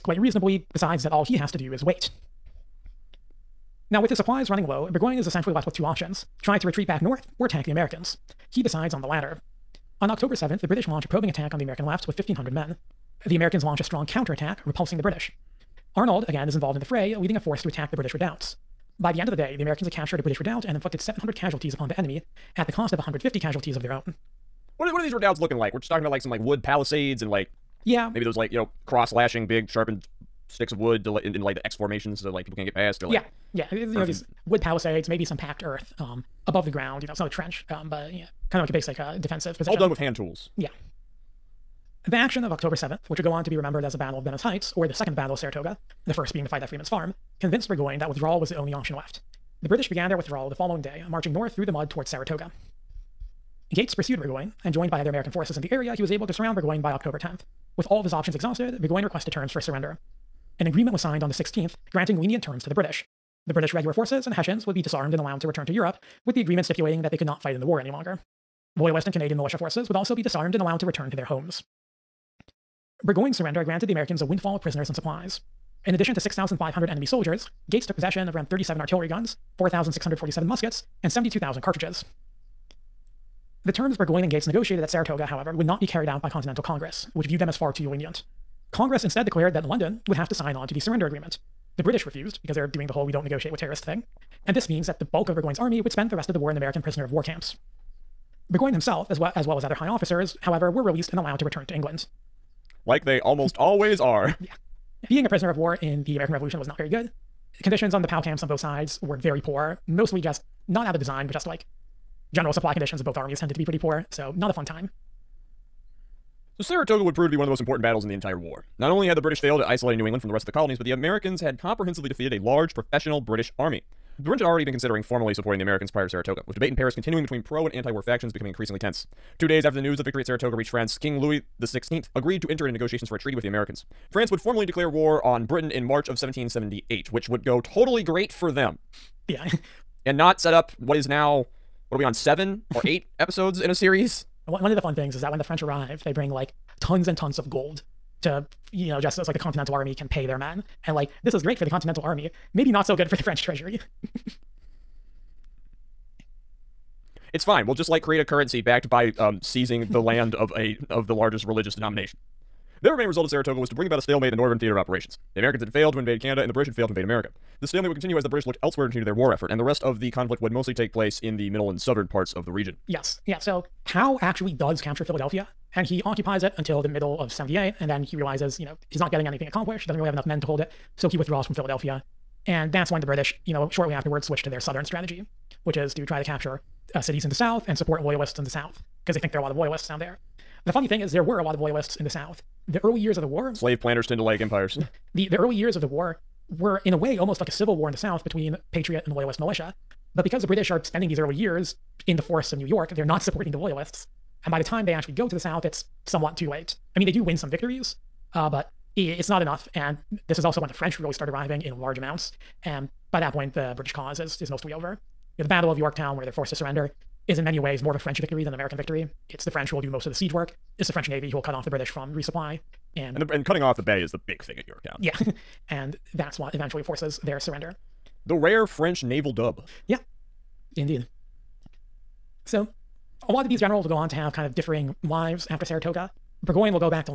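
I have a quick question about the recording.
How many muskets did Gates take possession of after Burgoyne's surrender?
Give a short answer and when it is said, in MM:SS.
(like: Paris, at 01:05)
4,647, at 01:19.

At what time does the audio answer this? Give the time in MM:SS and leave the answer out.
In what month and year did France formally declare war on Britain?
02:15.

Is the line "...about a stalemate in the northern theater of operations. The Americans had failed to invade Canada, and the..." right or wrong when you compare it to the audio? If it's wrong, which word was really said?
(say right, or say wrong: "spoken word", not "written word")
right.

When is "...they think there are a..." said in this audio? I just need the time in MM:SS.
03:09.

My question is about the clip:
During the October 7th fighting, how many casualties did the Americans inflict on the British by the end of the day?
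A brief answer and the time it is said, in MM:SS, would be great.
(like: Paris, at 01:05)
700, at 00:20.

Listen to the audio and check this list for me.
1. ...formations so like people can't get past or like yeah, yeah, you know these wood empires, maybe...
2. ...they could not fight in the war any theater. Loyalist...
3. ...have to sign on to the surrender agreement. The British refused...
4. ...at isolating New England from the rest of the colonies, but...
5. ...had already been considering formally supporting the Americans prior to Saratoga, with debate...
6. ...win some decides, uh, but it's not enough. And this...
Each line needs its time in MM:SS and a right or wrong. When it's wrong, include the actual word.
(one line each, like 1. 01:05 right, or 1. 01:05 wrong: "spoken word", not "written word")
1. 00:31 wrong: "palisades", not "empires"
2. 01:07 wrong: "longer", not "theater"
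3. 01:30 right
4. 01:59 right
5. 02:04 right
6. 03:27 wrong: "victories", not "decides".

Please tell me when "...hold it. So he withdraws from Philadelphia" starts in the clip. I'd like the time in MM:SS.
03:00.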